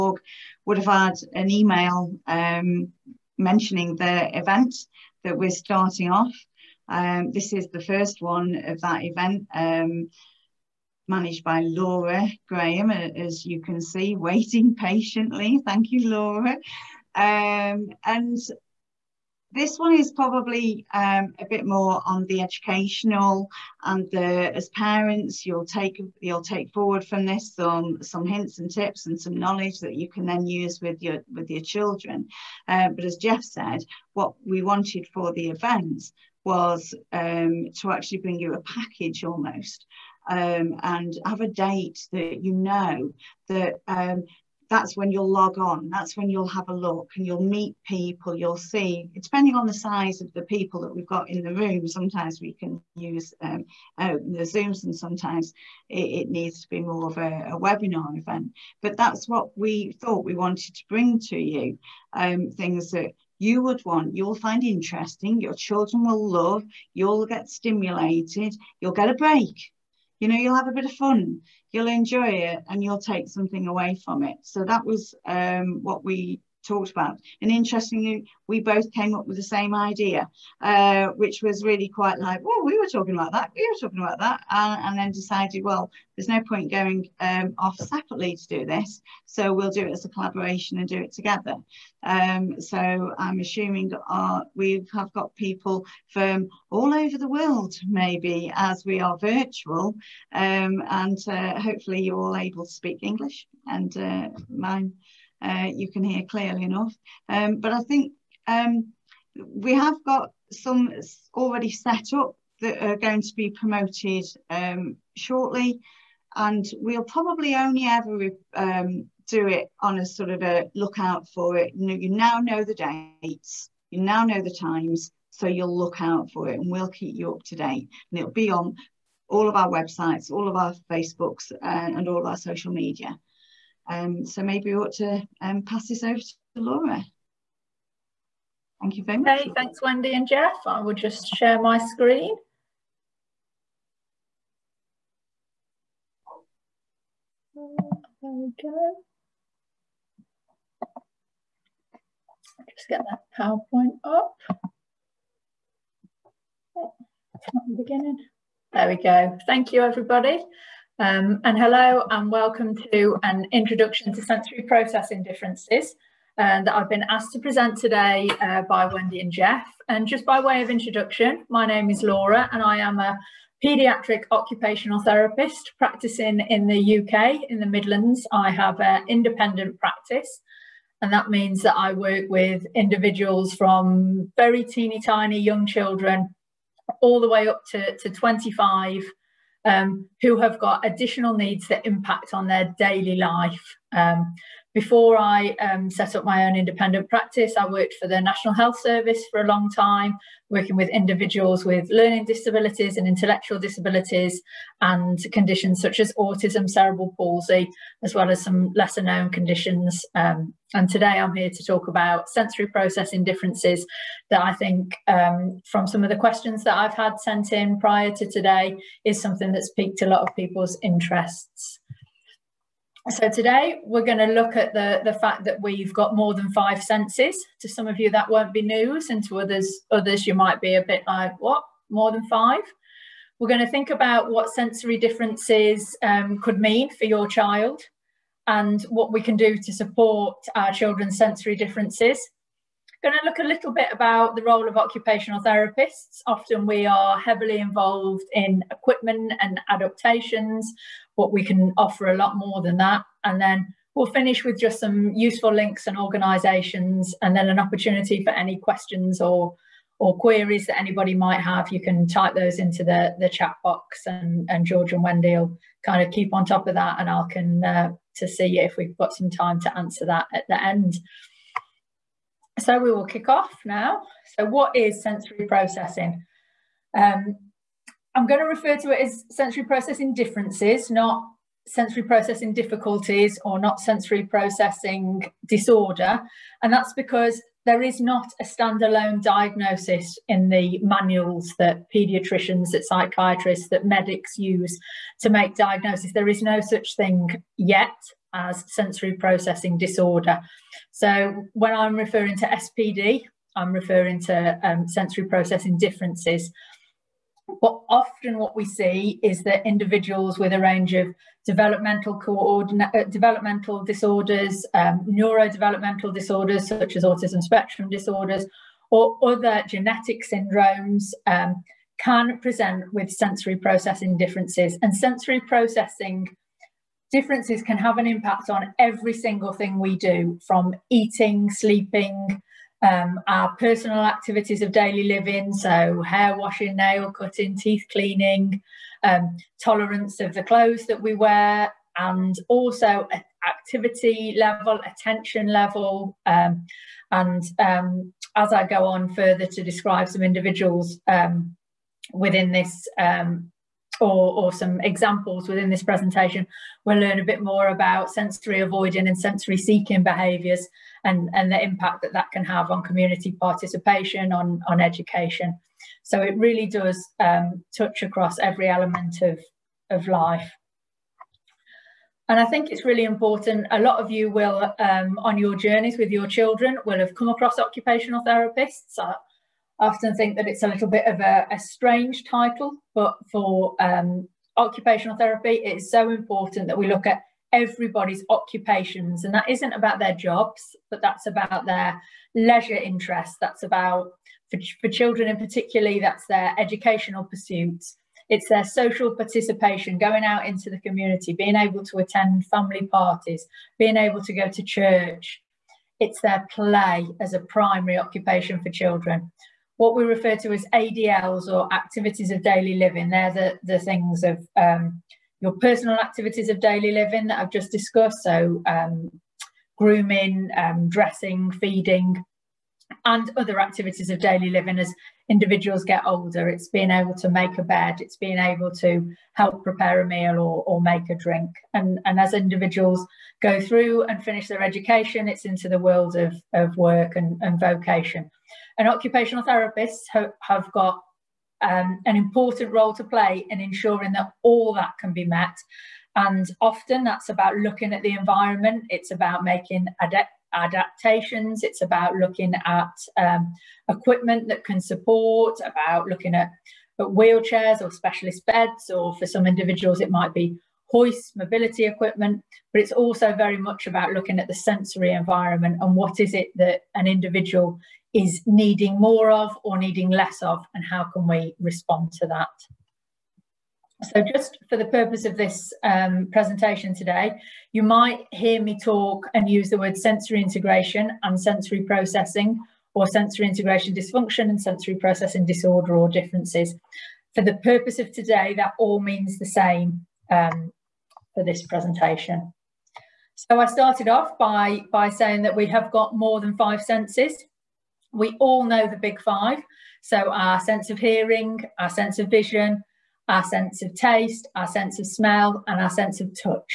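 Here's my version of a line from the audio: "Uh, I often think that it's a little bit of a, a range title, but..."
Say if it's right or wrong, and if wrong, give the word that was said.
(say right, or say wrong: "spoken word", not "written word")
wrong: "strange", not "range".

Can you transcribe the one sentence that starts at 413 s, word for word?
They're the, the things of um, your personal activities of daily living that I've just discussed.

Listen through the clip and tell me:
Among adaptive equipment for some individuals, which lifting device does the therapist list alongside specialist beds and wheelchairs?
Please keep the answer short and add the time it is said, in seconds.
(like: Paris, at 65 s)
hoists, at 460 s.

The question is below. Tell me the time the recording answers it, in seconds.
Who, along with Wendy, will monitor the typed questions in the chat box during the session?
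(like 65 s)
264 s.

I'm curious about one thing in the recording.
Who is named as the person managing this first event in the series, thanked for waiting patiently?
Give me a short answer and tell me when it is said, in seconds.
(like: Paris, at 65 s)
Laura Graham, at 11 s.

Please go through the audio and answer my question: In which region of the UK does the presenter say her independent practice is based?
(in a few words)
the Midlands.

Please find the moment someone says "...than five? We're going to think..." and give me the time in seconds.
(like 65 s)
232 s.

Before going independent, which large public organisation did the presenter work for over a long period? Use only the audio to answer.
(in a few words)
National Health Service.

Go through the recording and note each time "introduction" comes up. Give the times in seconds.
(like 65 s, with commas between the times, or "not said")
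163 s, 170 s.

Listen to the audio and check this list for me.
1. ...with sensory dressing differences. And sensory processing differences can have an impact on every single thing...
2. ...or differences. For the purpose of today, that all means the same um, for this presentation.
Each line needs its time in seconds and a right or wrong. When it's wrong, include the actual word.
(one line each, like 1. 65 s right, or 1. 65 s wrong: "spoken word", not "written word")
1. 322 s wrong: "processing", not "dressing"
2. 485 s right.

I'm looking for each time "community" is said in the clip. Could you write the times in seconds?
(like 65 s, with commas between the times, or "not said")
362 s, 400 s.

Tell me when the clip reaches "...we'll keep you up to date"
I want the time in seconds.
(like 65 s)
126 s.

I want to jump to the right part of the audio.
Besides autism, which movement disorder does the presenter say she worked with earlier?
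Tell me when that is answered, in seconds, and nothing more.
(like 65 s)
206 s.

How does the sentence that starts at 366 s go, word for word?
So it really does um, touch across every element of, of life.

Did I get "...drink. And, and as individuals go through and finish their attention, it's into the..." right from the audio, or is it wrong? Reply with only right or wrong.
wrong.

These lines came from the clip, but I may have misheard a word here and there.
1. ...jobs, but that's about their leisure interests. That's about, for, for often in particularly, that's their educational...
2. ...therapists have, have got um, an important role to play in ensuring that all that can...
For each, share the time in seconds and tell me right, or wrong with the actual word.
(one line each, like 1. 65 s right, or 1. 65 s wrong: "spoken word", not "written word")
1. 390 s wrong: "children", not "often"
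2. 439 s right.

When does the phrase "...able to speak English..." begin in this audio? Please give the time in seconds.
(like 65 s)
102 s.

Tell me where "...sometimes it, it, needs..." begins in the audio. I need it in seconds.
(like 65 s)
54 s.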